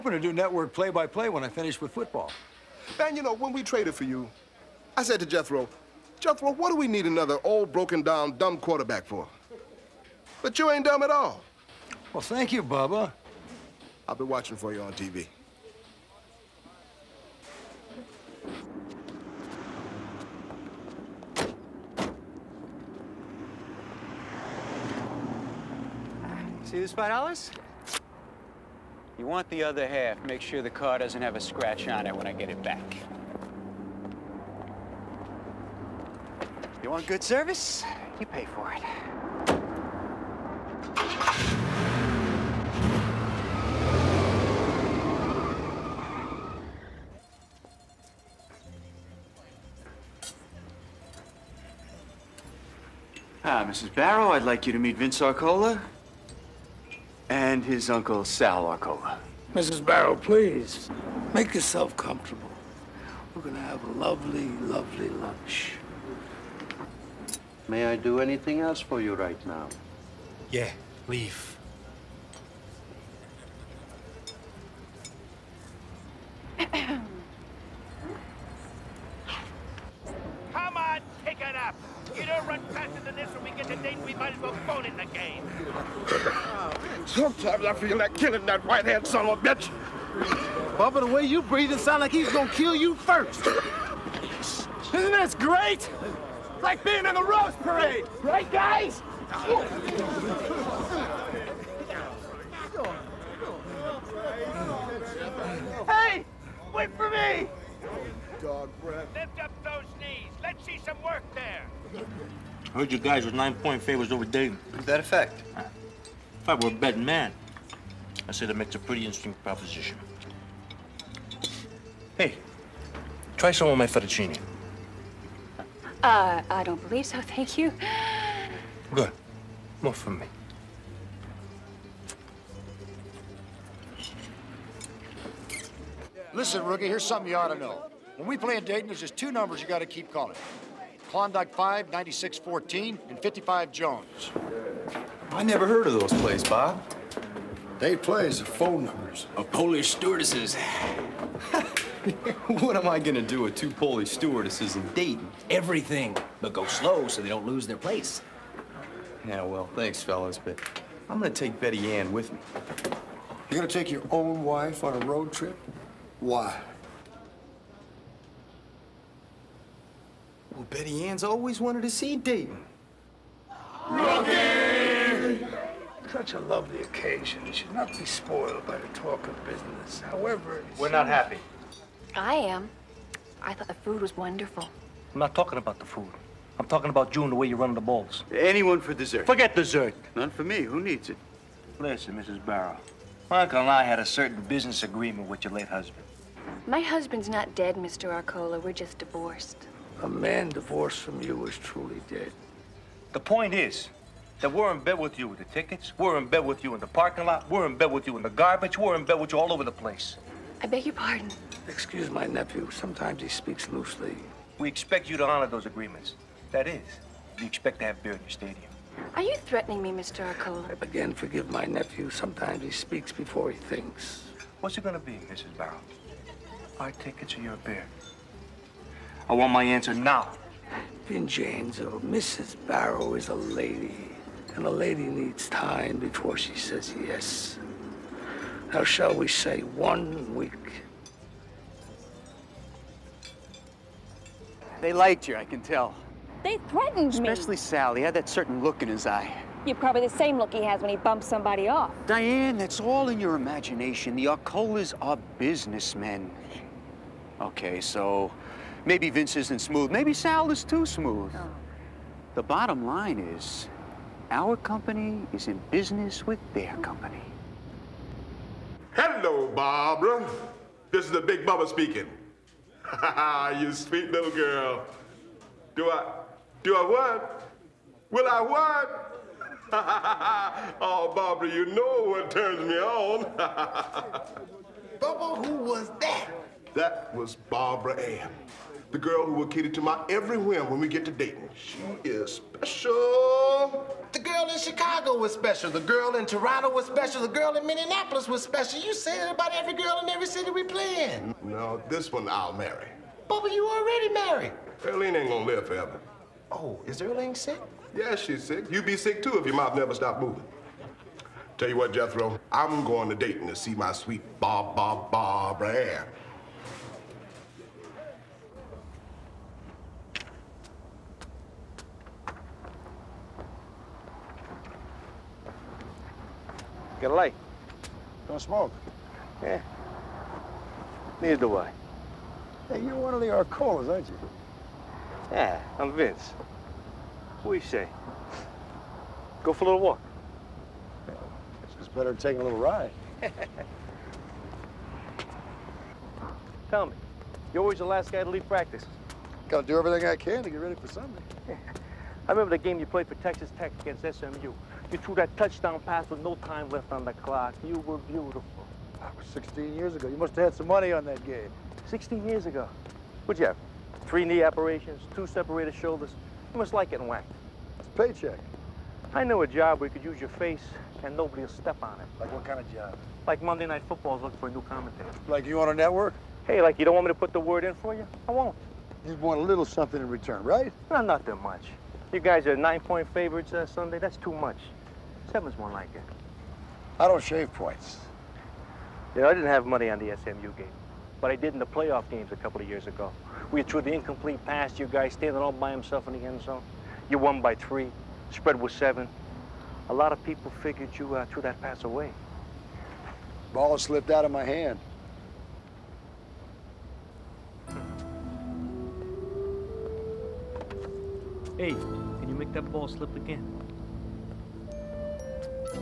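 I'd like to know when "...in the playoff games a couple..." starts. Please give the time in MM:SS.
06:31.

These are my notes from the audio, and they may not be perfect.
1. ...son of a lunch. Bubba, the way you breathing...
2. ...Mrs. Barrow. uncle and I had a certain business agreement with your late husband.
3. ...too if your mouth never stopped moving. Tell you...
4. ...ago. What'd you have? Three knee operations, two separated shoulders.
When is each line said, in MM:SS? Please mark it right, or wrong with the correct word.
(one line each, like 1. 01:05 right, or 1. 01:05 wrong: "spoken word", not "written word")
1. 01:29 wrong: "bitch", not "lunch"
2. 03:12 right
3. 05:09 right
4. 06:02 right.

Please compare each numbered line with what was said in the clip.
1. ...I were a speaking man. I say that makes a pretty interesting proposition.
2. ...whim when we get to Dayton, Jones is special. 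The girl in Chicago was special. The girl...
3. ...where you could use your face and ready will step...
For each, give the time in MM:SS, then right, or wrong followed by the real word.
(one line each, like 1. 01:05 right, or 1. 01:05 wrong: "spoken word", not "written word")
1. 01:56 wrong: "betting", not "speaking"
2. 04:50 wrong: "She", not "Jones"
3. 06:09 wrong: "nobody", not "ready".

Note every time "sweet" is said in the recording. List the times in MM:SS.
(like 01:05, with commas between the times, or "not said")
04:33, 05:13.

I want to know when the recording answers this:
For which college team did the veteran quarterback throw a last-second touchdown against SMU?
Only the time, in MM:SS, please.
05:53.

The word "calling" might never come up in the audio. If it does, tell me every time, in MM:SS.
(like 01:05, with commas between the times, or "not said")
02:20.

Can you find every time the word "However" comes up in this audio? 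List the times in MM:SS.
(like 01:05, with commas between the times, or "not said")
03:00.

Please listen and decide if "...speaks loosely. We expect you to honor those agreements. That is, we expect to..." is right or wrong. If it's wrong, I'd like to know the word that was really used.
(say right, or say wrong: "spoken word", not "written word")
right.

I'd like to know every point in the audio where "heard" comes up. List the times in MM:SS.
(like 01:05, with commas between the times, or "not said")
01:52, 02:25.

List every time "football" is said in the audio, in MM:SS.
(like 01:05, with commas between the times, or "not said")
00:01, 06:13.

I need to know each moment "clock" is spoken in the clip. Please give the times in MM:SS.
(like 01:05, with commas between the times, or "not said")
05:57.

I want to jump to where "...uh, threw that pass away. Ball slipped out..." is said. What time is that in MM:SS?
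06:41.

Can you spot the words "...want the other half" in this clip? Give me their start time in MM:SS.
00:29.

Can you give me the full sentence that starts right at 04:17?
Okay, so maybe Vince isn't smooth.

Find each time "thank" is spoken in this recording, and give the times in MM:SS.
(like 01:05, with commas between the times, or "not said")
00:12, 02:07, 02:39.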